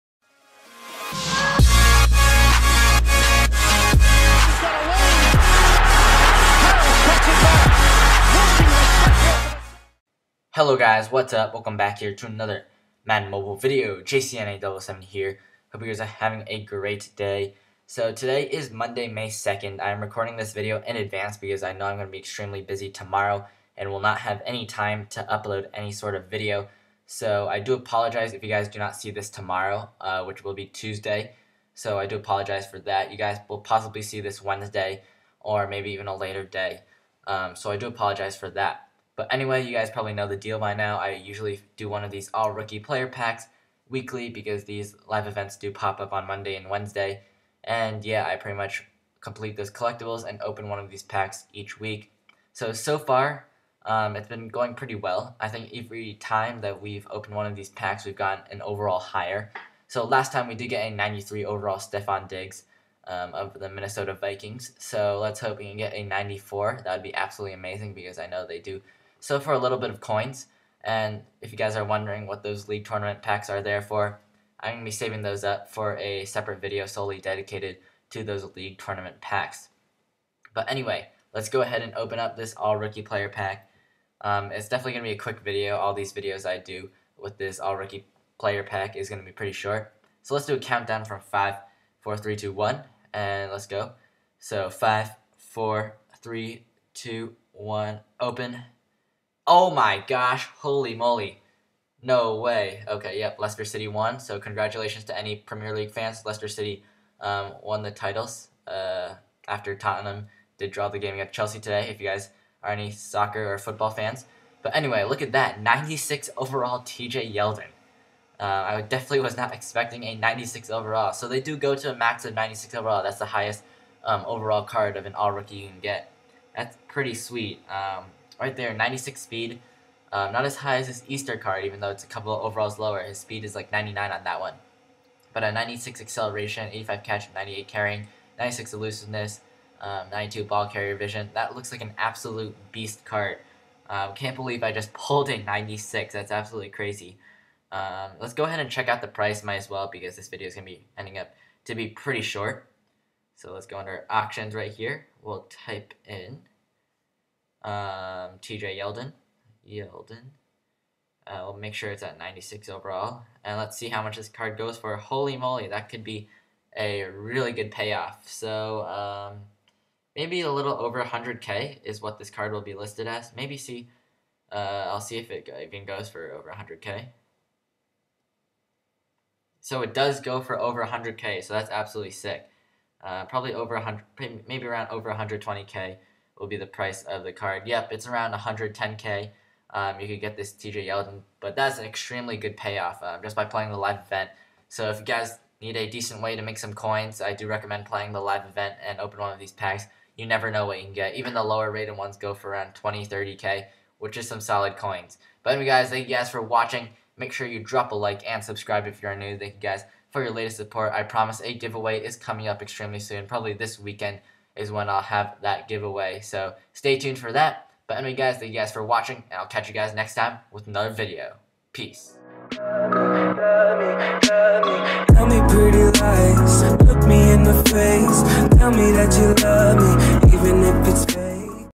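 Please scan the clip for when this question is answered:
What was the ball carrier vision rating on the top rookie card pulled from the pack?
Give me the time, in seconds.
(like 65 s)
140 s.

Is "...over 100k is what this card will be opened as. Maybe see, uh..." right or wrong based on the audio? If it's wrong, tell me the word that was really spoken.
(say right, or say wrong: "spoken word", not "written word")
wrong: "listed", not "opened".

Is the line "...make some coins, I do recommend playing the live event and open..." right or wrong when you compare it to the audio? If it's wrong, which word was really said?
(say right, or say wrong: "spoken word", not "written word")
right.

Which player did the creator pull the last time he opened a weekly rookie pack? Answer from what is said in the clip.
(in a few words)
Stefon Diggs.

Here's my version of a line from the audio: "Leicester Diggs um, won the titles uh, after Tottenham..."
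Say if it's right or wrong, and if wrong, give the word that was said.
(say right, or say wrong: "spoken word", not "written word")
wrong: "City", not "Diggs".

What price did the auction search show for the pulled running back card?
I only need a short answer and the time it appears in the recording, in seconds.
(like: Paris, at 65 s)
110k, at 188 s.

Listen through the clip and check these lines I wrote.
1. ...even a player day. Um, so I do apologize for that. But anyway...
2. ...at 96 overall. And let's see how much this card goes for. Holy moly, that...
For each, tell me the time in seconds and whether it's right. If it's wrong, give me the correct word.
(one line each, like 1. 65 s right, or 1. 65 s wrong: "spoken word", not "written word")
1. 35 s wrong: "later", not "player"
2. 162 s right.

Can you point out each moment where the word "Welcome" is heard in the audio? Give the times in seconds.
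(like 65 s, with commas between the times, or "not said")
11 s.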